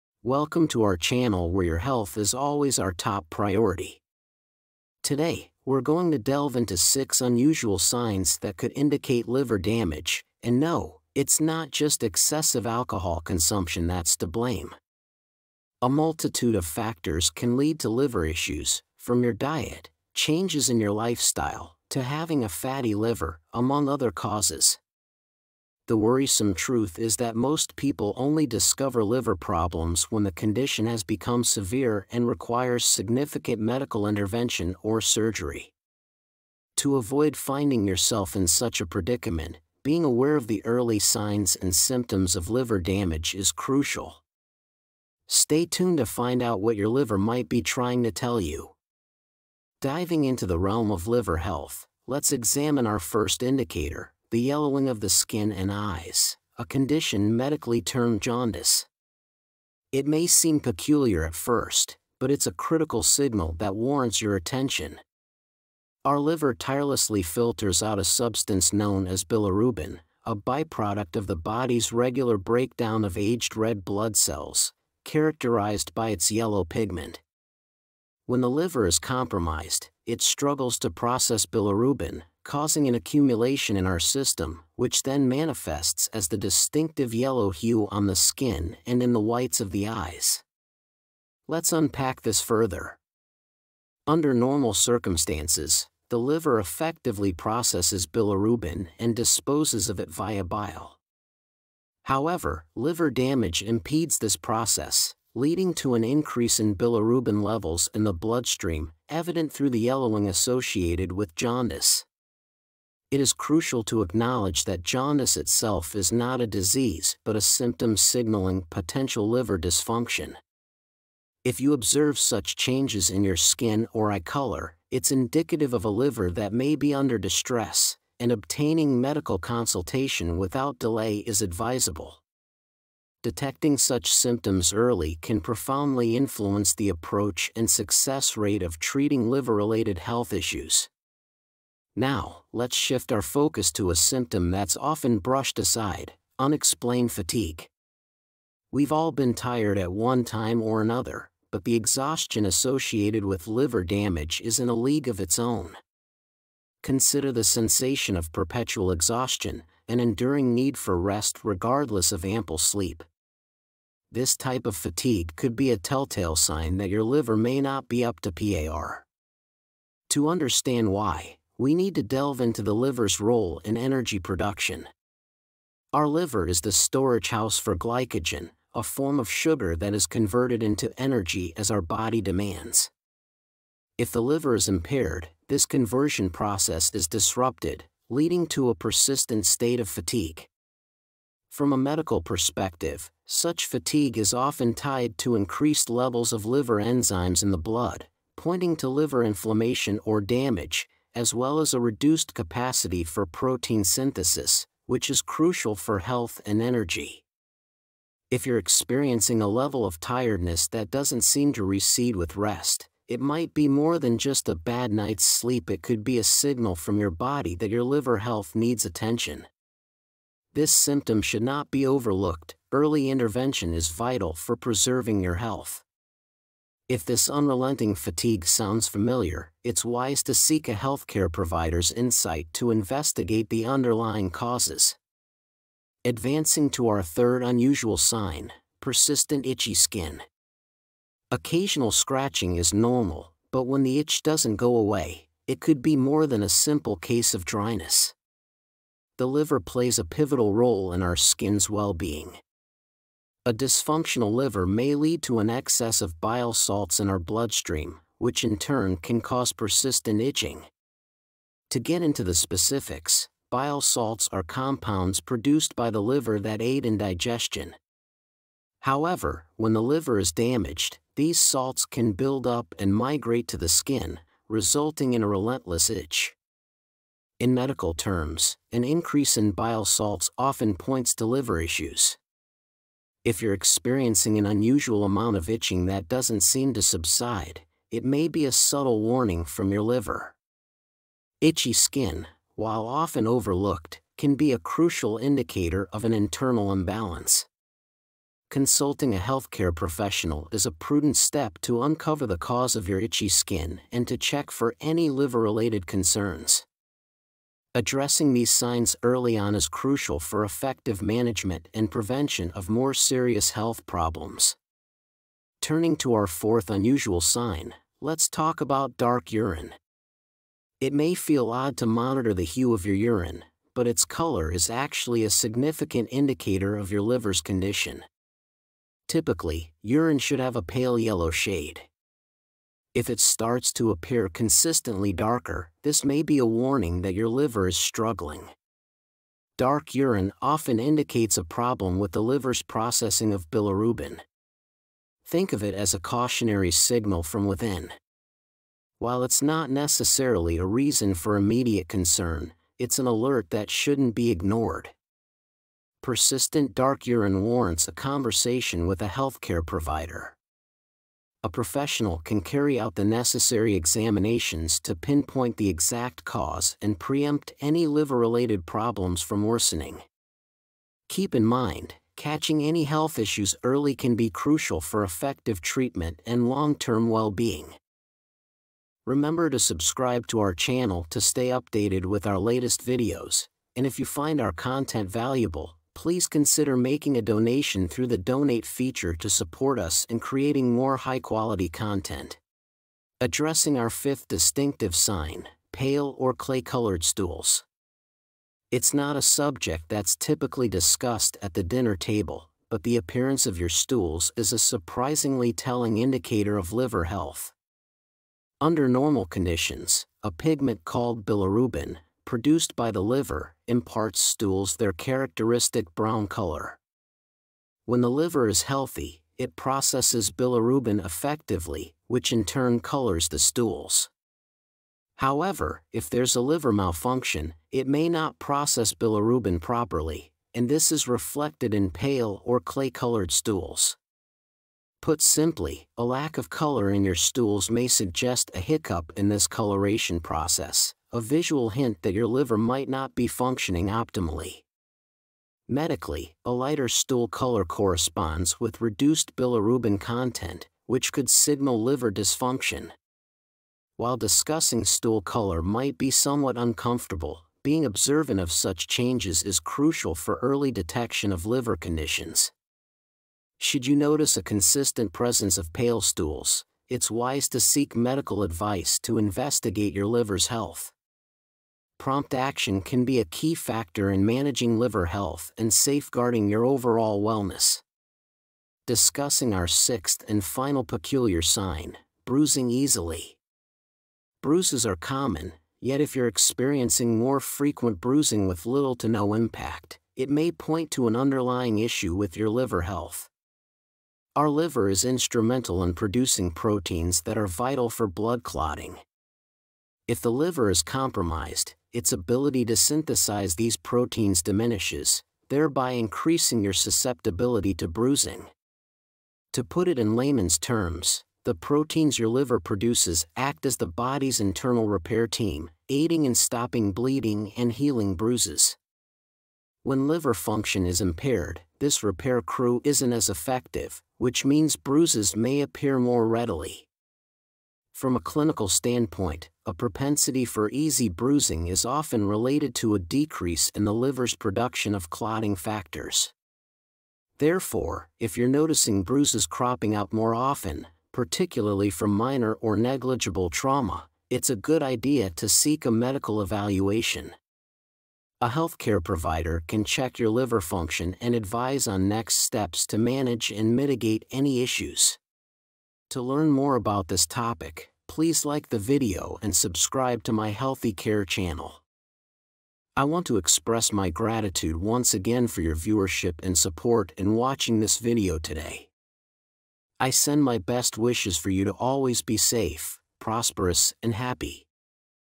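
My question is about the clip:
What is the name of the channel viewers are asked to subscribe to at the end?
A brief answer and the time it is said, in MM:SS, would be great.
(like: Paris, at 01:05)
Healthy Care, at 09:20.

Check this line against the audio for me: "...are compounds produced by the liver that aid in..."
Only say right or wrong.
right.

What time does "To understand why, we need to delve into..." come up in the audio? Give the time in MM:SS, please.
02:50.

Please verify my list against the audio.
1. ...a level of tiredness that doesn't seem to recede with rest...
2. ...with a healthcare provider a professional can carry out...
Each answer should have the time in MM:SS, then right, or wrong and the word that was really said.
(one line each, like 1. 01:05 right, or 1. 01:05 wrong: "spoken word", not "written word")
1. 03:29 right
2. 05:58 right.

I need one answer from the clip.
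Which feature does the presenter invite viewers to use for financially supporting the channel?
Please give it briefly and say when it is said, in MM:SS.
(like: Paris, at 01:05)
donate feature, at 06:28.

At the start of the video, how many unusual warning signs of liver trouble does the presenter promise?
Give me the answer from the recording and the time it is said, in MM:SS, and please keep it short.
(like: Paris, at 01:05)
6, at 00:06.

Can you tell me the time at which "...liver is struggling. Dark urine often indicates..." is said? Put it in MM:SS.
05:37.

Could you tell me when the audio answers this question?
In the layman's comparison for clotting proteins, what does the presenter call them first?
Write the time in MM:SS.
08:34.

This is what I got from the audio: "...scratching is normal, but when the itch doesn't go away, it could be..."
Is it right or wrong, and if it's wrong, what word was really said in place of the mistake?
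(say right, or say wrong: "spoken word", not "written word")
right.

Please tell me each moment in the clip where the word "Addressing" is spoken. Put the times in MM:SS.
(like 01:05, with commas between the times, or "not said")
05:07, 06:33.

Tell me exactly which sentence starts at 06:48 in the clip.
Under normal conditions, a pigment called bilirubin, produced by the liver, imparts stools their characteristic brown color.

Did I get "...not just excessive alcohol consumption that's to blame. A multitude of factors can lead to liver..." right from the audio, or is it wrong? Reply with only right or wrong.
right.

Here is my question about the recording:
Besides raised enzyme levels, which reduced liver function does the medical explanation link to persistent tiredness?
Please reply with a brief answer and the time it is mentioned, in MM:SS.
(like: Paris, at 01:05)
protein synthesis, at 03:23.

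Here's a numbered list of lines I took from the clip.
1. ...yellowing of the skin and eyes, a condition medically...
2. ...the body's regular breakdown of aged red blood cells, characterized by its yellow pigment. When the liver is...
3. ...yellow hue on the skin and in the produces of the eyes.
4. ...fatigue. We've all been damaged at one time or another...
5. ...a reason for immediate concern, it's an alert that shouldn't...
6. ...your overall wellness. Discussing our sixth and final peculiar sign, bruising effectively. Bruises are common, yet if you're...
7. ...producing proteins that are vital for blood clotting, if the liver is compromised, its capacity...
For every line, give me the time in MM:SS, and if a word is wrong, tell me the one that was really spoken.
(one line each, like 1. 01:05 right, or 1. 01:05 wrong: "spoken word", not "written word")
1. 00:54 right
2. 01:11 right
3. 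01:27 wrong: "whites", not "produces"
4. 02:27 wrong: "tired", not "damaged"
5. 05:50 right
6. 07:56 wrong: "easily", not "effectively"
7. 08:15 wrong: "ability", not "capacity".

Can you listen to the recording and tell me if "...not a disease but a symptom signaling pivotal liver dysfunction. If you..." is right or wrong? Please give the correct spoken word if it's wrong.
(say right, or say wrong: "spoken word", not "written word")
wrong: "potential", not "pivotal".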